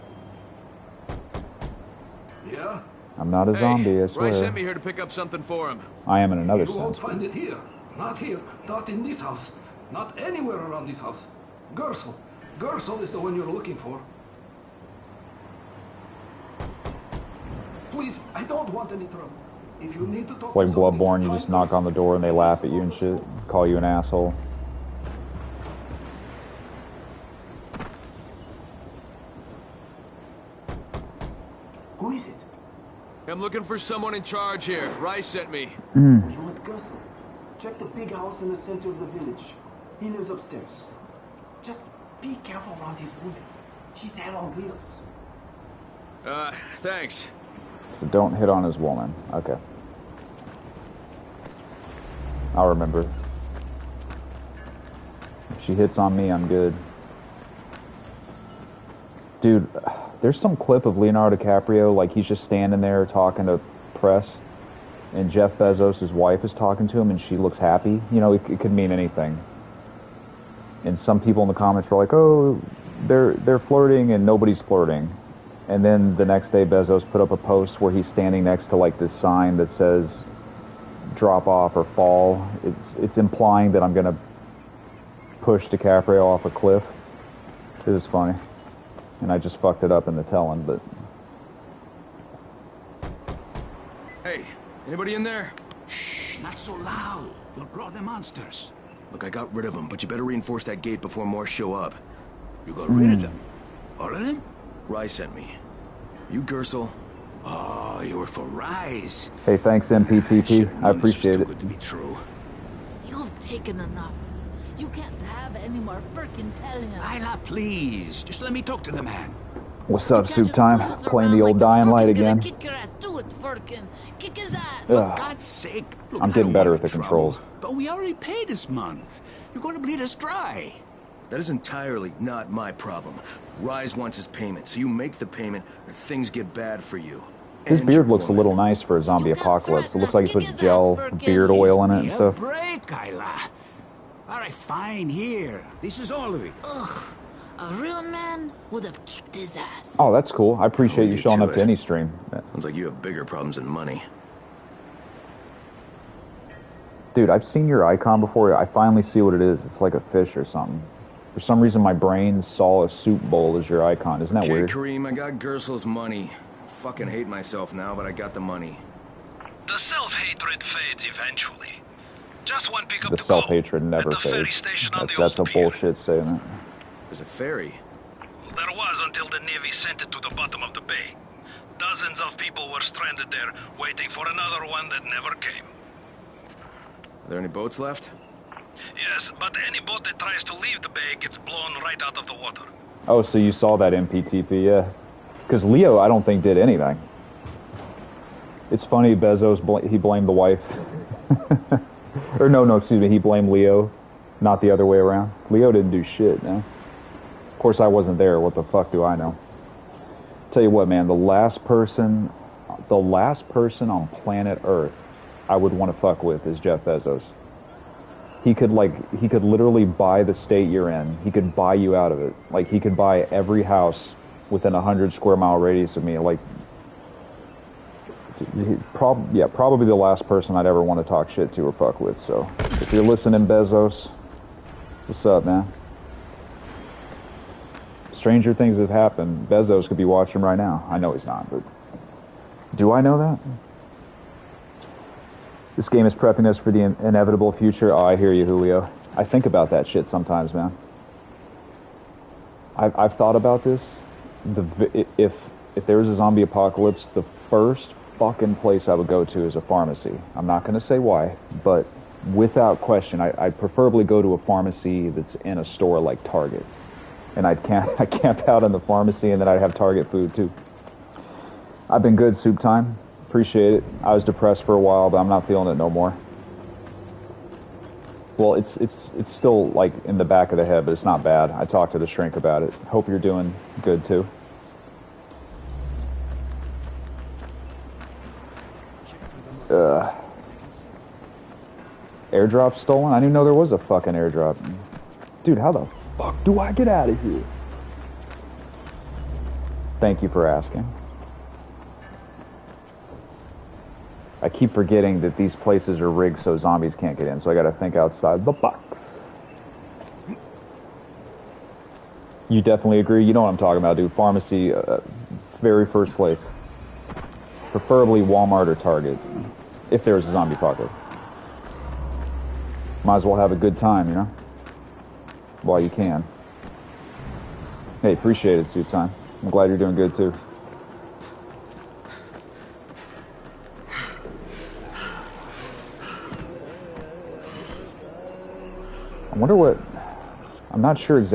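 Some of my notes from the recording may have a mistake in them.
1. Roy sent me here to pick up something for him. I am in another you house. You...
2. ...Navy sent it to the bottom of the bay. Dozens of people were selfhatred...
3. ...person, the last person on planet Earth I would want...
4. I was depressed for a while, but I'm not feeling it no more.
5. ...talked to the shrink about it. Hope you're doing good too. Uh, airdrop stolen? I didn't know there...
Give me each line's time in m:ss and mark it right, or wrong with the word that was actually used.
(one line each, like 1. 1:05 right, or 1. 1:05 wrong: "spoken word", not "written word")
1. 0:04 wrong: "sense", not "house"
2. 2:59 wrong: "stranded", not "selfhatred"
3. 3:31 right
4. 4:34 right
5. 4:41 right.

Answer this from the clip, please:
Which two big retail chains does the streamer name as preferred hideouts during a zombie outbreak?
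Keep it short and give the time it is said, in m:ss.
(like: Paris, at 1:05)
Walmart or Target, at 5:18.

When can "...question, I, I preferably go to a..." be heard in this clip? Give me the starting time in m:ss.
4:22.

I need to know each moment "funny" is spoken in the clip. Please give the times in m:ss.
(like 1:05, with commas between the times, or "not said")
1:28, 3:18.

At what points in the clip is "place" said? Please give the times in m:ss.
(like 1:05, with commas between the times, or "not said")
4:18, 5:05, 5:16.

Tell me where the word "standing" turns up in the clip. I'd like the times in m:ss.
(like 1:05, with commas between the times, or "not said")
1:02, 1:18.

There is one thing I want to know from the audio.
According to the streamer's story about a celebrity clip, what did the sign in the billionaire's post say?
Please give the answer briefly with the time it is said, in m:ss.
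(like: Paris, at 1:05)
Drop off or fall, at 1:21.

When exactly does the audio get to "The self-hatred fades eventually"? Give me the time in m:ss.
2:49.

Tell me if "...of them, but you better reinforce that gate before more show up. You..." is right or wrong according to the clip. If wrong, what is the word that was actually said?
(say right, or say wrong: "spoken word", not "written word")
right.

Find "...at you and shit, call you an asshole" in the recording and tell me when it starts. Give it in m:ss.
0:22.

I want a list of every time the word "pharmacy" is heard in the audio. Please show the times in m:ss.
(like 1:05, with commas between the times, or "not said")
4:19, 4:24, 4:28, 5:14.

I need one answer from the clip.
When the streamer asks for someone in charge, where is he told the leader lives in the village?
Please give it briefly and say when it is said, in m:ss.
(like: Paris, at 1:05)
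The big house in the center, at 0:37.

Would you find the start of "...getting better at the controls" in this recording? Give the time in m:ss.
2:06.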